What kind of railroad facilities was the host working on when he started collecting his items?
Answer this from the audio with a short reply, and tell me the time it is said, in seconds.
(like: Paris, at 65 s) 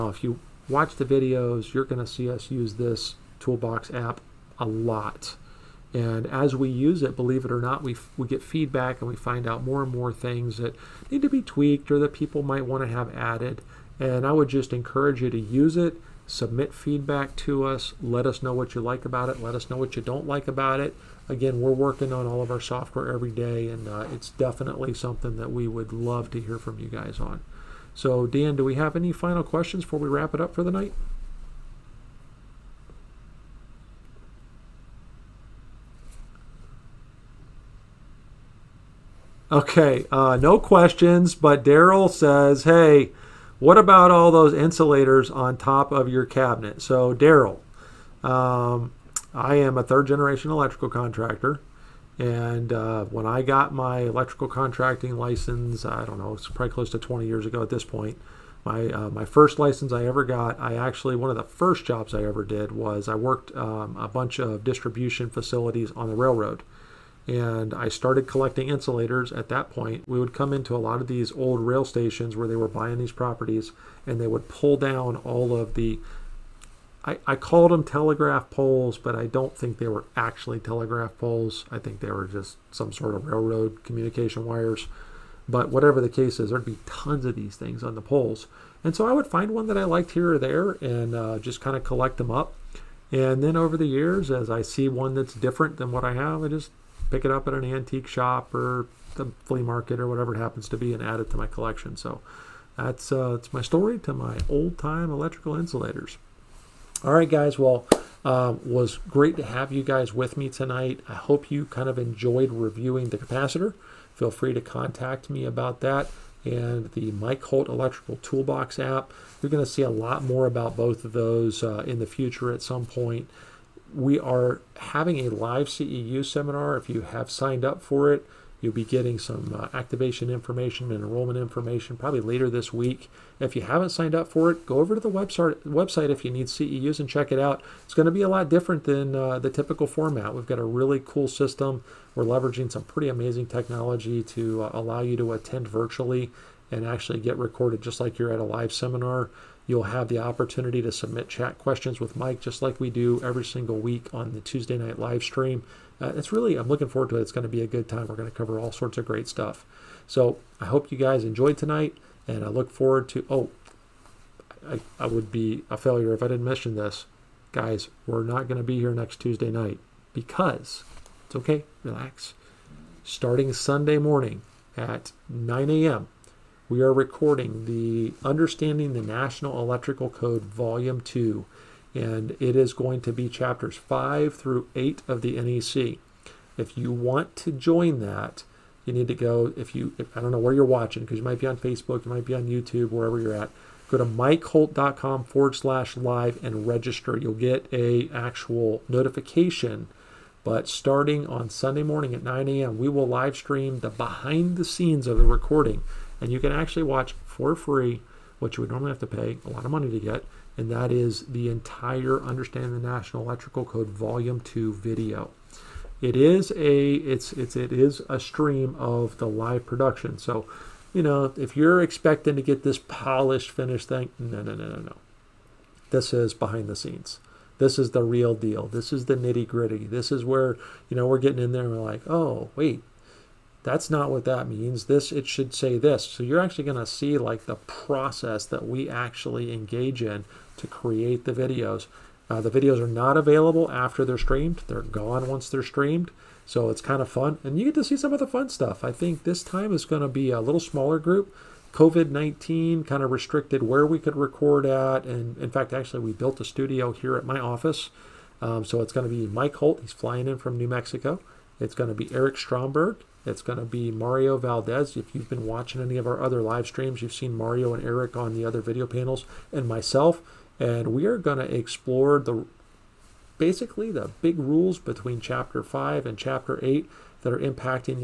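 distribution facilities, at 64 s.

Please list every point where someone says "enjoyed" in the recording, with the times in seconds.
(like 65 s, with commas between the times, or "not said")
111 s, 161 s.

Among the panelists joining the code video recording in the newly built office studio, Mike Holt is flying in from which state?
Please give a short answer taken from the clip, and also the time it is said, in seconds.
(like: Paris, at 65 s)
New Mexico, at 260 s.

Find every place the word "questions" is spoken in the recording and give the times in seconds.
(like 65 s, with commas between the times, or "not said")
29 s, 40 s, 151 s.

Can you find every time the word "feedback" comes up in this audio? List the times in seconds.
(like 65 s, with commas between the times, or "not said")
8 s, 16 s.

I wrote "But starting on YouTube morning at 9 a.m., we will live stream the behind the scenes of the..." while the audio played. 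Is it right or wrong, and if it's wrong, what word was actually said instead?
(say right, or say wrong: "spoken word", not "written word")
wrong: "Sunday", not "YouTube".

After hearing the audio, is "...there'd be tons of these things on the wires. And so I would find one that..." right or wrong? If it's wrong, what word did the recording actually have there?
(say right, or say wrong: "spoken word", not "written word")
wrong: "poles", not "wires".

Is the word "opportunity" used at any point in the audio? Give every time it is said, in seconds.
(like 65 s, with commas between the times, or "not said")
150 s.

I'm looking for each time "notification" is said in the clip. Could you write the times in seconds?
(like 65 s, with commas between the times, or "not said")
198 s.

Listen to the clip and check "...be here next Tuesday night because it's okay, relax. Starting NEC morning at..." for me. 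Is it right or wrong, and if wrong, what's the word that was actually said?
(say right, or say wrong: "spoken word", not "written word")
wrong: "Sunday", not "NEC".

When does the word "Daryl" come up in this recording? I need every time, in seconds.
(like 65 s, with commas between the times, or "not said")
41 s, 47 s.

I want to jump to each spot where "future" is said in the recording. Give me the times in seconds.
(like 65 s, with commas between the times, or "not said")
122 s.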